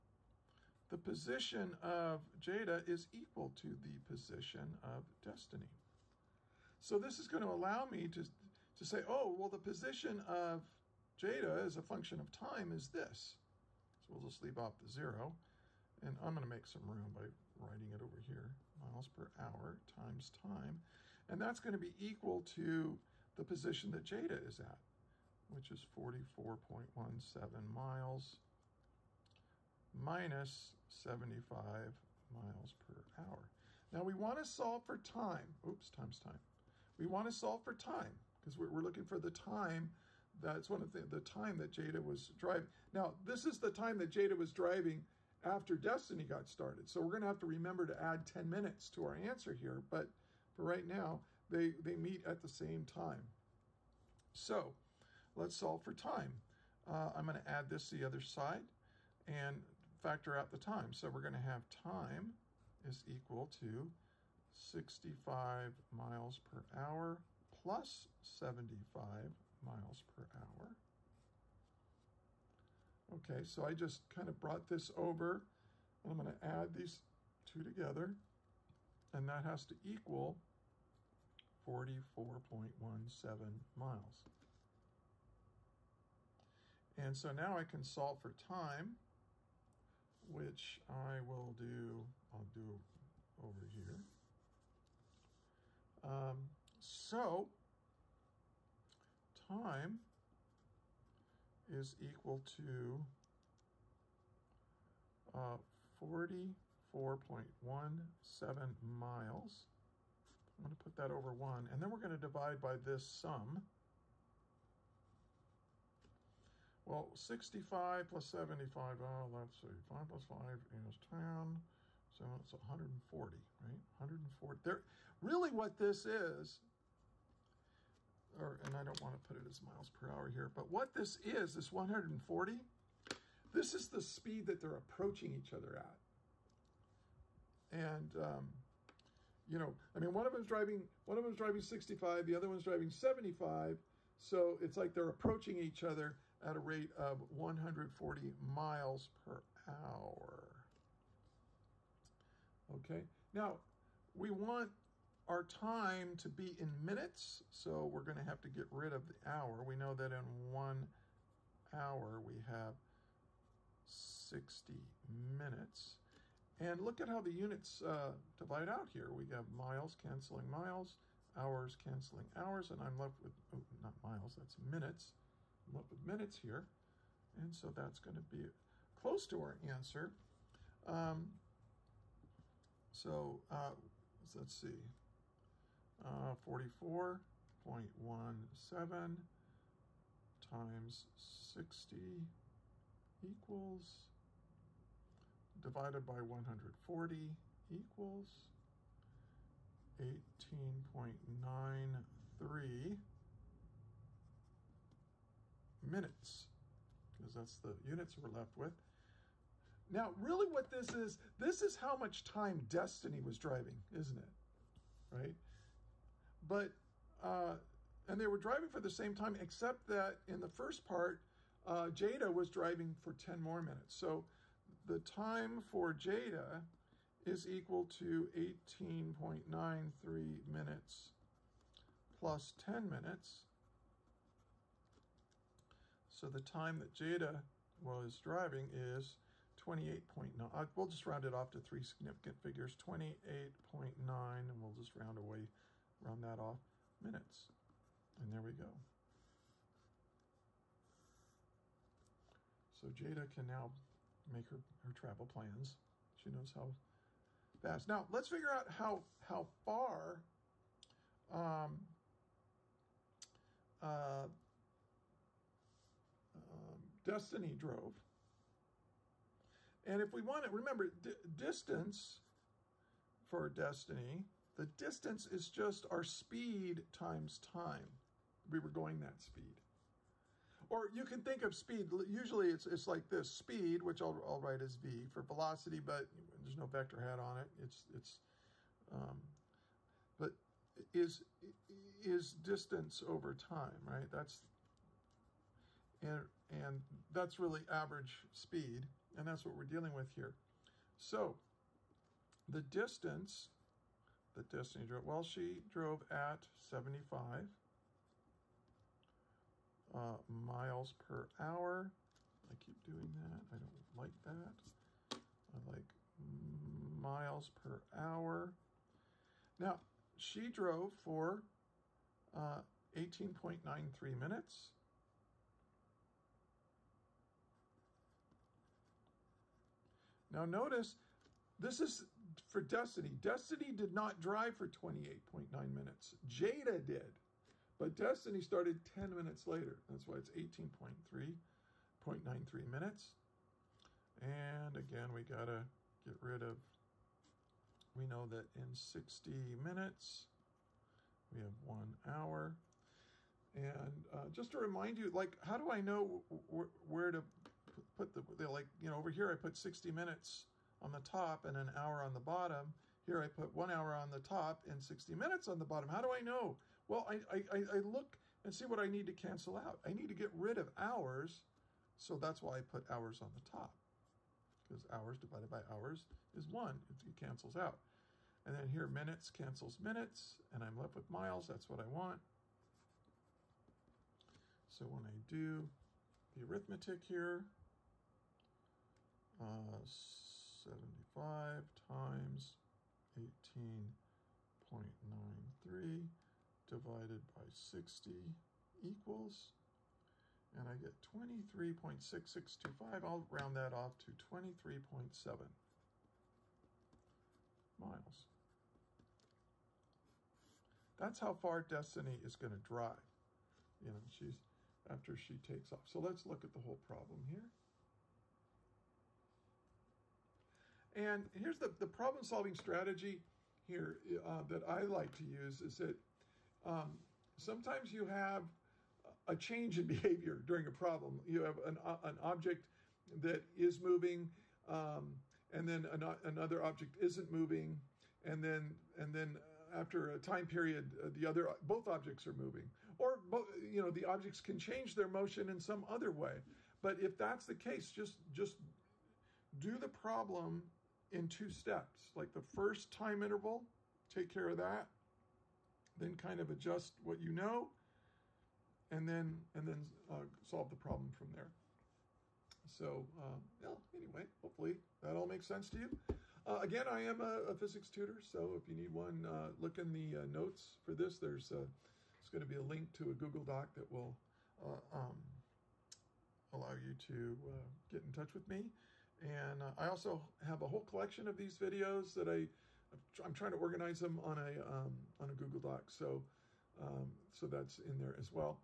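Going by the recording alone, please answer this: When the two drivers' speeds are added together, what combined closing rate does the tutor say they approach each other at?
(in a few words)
140 miles per hour.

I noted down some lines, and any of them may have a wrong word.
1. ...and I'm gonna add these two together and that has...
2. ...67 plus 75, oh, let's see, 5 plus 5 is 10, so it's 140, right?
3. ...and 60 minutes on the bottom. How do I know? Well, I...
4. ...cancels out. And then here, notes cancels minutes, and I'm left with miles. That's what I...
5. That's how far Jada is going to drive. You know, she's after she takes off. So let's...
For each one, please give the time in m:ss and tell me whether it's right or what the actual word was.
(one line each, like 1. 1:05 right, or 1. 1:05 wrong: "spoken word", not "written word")
1. 1:16 right
2. 1:57 wrong: "65", not "67"
3. 6:04 right
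4. 6:17 wrong: "minutes", not "notes"
5. 6:50 wrong: "Destiny", not "Jada".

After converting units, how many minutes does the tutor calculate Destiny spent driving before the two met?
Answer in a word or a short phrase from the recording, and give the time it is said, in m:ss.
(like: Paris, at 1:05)
18.93 minutes, at 3:19.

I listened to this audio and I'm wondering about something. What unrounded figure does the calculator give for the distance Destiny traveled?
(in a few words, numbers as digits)
23.6625.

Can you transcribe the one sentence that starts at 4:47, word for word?
It's, it's um, but is, is distance over time, right?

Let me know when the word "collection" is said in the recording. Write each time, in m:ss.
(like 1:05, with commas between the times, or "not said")
8:00.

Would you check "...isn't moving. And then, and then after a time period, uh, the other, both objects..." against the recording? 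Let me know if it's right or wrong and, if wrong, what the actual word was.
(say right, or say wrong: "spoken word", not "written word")
right.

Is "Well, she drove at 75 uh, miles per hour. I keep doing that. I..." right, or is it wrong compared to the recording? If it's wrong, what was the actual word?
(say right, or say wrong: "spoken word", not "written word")
right.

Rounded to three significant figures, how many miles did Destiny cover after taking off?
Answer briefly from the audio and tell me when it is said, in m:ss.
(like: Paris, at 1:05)
23.7 miles, at 6:44.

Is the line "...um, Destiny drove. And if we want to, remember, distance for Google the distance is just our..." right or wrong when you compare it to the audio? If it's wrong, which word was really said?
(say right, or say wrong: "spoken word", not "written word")
wrong: "Destiny", not "Google".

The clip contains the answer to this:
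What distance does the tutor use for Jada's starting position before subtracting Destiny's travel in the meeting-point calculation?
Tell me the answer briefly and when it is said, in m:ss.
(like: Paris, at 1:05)
44.17 miles, at 0:25.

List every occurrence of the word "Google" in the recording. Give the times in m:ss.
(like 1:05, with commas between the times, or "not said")
7:53, 8:05.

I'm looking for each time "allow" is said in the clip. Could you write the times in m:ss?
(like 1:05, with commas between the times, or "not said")
0:07, 7:56.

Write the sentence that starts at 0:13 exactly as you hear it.
So we'll just leave off the zero.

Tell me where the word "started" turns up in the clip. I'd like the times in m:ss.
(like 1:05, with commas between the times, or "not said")
0:46, 5:38.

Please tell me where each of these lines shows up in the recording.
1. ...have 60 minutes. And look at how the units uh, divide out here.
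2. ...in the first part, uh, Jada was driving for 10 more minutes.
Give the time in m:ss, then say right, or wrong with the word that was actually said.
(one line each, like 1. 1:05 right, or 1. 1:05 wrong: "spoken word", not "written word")
1. 2:42 right
2. 3:40 right.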